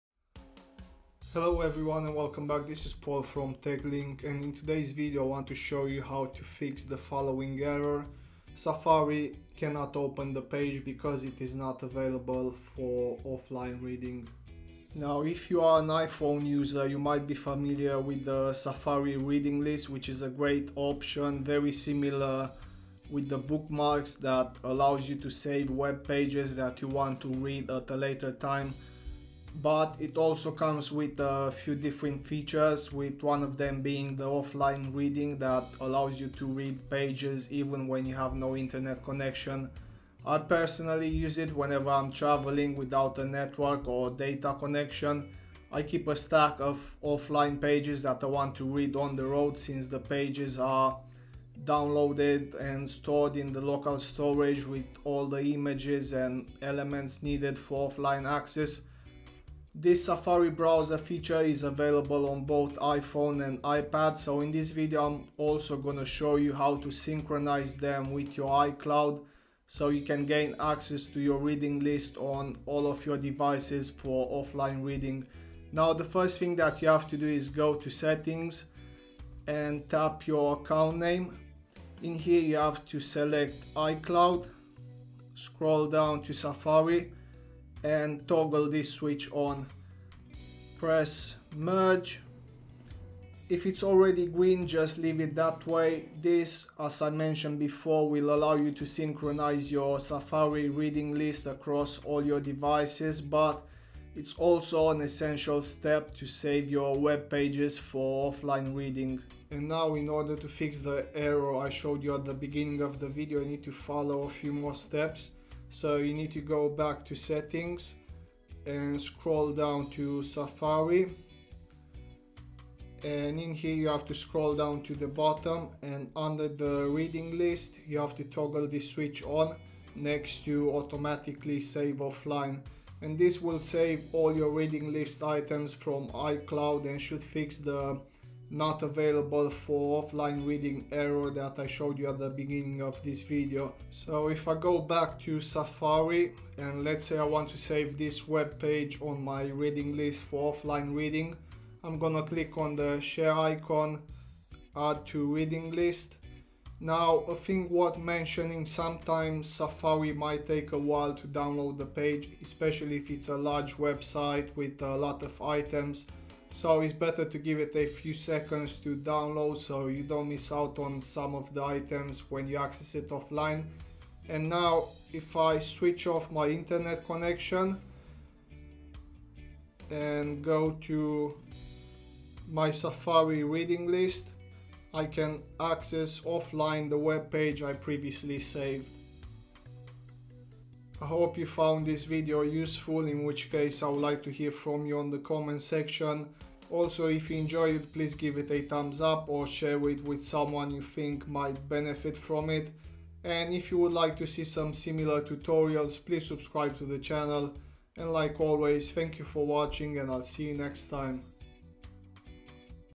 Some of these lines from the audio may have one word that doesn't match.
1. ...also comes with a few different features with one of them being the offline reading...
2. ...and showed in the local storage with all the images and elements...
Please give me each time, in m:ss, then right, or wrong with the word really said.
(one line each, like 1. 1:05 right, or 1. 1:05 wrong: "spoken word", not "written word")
1. 0:30 right
2. 0:52 wrong: "stored", not "showed".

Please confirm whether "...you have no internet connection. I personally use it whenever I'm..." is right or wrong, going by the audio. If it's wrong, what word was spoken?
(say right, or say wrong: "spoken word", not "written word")
right.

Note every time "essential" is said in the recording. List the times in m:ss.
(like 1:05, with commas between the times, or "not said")
1:45.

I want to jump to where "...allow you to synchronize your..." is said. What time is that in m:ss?
1:38.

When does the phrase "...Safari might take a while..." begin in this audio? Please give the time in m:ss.
2:39.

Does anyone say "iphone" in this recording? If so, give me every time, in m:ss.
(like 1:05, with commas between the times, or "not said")
0:15, 1:02.